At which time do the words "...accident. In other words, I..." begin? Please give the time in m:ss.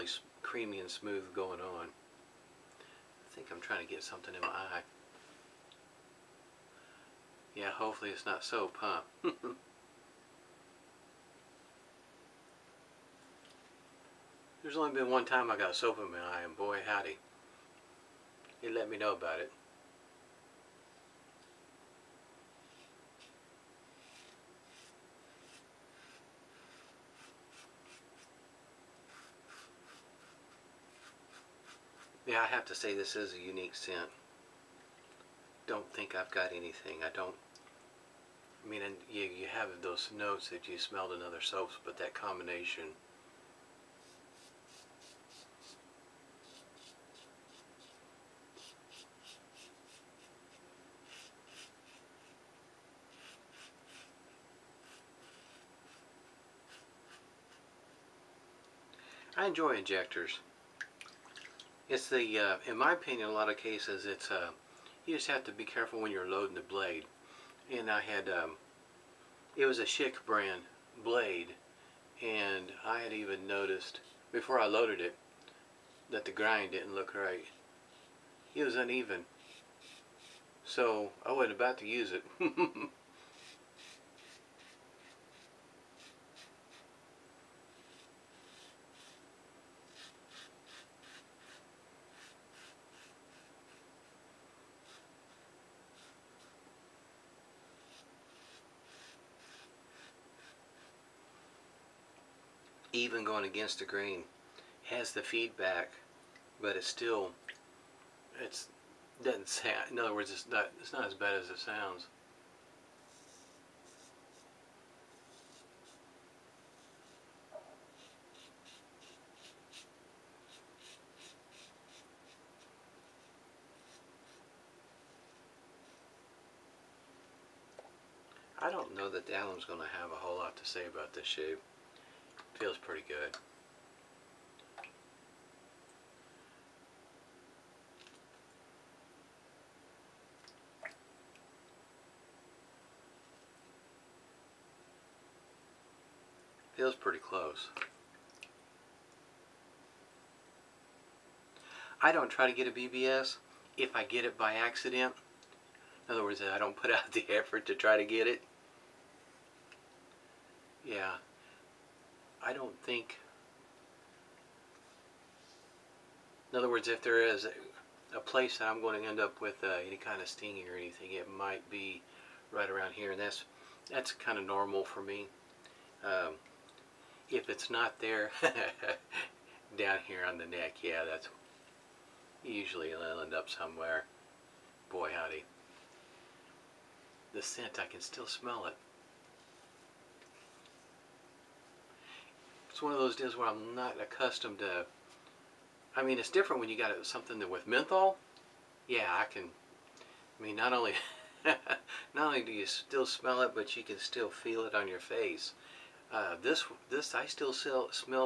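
2:34.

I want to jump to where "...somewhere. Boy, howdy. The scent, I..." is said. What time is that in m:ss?
3:03.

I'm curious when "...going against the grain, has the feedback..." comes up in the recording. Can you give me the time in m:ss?
1:43.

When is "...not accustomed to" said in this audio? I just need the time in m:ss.
3:13.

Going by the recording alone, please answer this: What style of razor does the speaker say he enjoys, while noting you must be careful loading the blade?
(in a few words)
Injectors.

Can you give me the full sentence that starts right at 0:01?
I think I'm trying to get something in my eye.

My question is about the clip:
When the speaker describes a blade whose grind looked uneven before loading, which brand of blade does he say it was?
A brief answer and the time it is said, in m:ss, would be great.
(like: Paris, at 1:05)
Schick, at 1:09.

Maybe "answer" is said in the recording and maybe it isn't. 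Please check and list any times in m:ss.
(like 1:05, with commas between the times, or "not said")
not said.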